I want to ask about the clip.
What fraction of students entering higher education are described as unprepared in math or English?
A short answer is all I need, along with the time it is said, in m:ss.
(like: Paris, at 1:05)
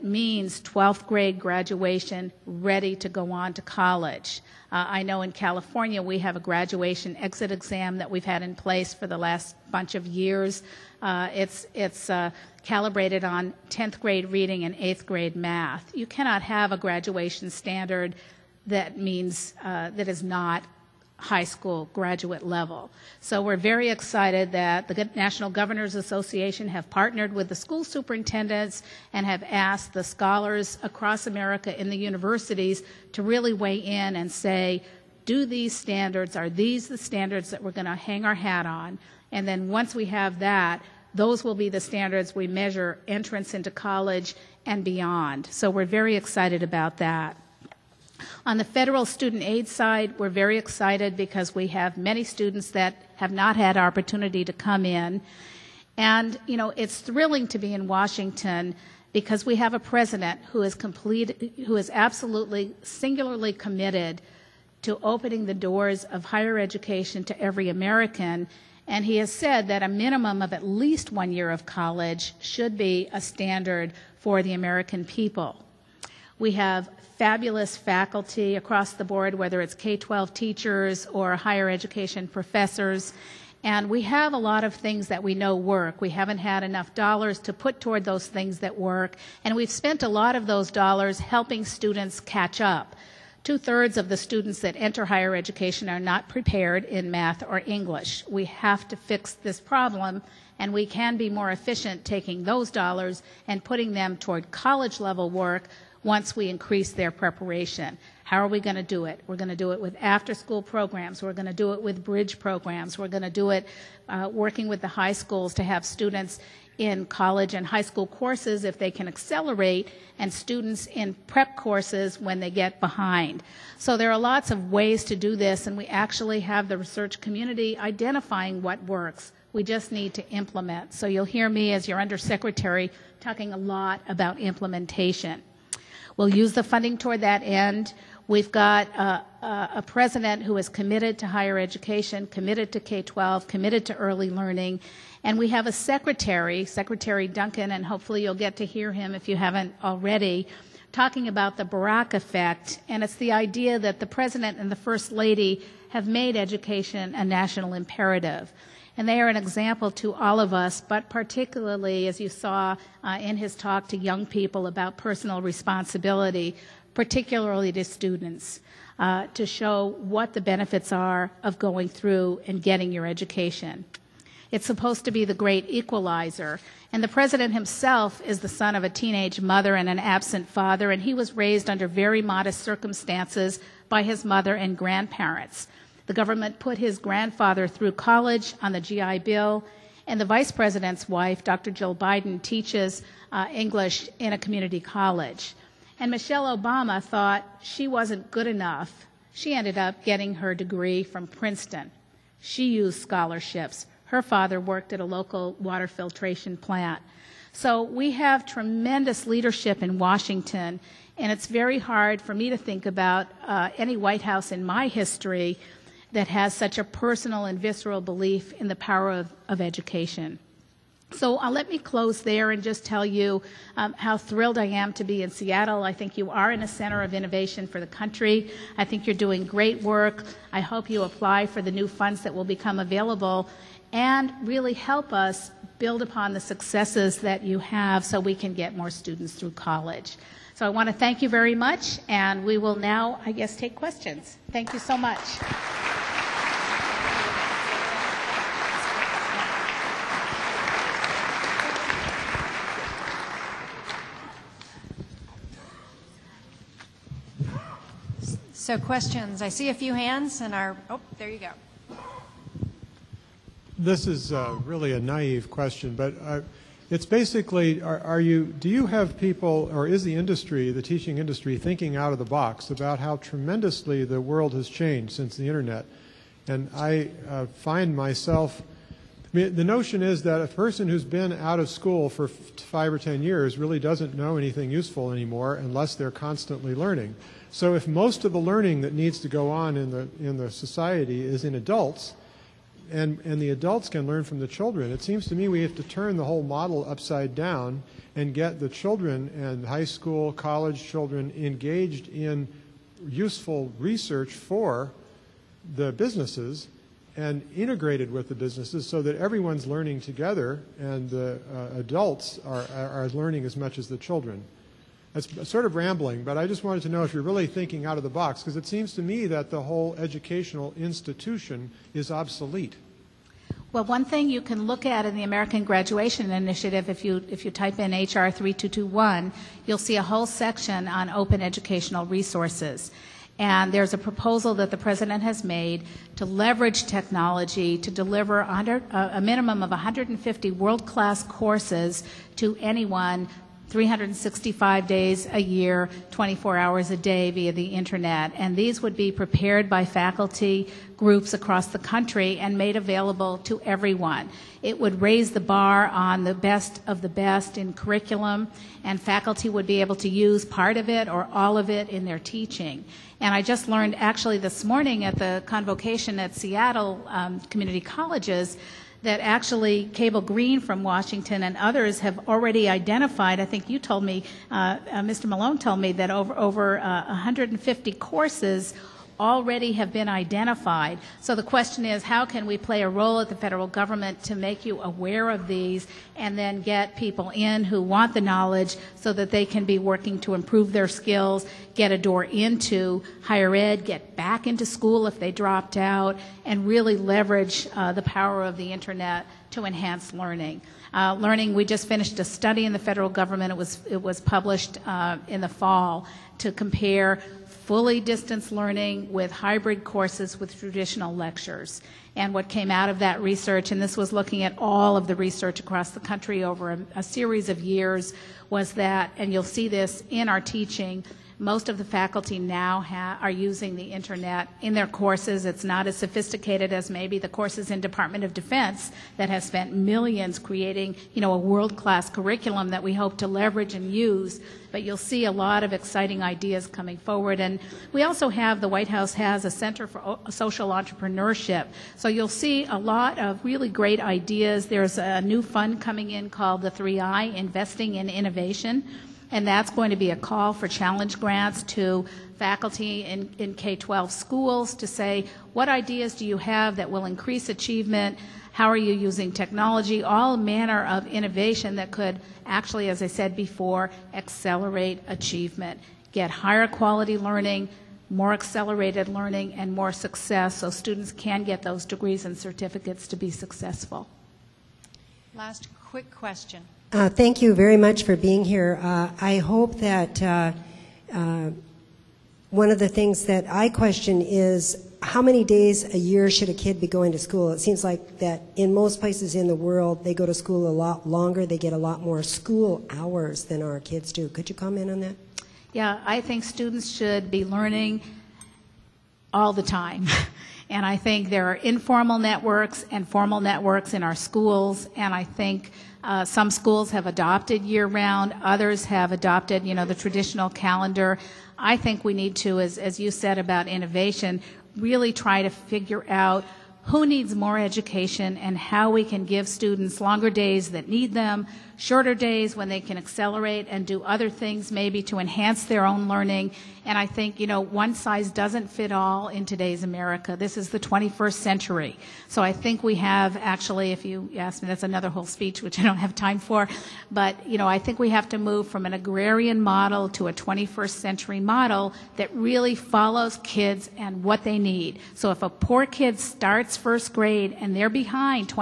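Two thirds, at 1:33.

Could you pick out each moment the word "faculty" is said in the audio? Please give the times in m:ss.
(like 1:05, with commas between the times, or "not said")
1:17, 5:49, 5:59, 7:01, 7:32.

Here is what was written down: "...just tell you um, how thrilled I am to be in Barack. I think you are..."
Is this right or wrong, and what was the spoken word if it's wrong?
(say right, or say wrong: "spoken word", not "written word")
wrong: "Seattle", not "Barack".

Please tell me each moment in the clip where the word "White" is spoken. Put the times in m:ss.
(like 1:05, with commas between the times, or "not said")
3:33, 7:18.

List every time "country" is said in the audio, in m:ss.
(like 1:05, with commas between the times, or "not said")
3:47, 5:51, 6:56.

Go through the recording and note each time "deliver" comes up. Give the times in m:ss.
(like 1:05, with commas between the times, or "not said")
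5:37.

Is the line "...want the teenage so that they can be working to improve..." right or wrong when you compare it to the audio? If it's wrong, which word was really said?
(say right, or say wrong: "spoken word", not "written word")
wrong: "knowledge", not "teenage".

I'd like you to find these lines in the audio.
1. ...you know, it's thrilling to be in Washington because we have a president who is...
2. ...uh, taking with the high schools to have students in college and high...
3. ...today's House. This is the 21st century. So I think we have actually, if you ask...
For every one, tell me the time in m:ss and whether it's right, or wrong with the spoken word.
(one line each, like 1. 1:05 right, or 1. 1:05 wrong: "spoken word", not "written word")
1. 0:56 right
2. 1:54 wrong: "working", not "taking"
3. 8:49 wrong: "America", not "House".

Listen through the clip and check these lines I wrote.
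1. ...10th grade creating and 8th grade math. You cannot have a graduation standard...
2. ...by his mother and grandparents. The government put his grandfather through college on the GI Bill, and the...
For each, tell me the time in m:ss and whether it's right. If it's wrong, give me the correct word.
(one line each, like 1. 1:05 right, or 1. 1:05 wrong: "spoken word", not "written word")
1. 0:13 wrong: "reading", not "creating"
2. 3:03 right.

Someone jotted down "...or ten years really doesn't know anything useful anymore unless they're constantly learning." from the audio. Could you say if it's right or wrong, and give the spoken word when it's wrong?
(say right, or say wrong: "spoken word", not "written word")
right.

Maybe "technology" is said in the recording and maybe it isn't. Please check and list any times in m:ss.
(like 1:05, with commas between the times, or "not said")
5:36, 7:39.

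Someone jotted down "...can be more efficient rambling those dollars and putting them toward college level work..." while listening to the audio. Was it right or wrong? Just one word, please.
wrong.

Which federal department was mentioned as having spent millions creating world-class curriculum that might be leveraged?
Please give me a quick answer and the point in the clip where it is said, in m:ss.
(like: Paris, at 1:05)
Department of Defense, at 7:07.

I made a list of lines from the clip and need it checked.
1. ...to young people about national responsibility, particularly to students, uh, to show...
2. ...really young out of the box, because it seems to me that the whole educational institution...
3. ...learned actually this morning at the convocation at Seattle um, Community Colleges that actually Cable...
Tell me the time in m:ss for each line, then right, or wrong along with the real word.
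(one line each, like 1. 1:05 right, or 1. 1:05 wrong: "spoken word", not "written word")
1. 2:43 wrong: "personal", not "national"
2. 5:17 wrong: "thinking", not "young"
3. 6:03 right.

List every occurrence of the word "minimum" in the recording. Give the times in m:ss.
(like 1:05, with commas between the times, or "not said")
1:09, 5:39.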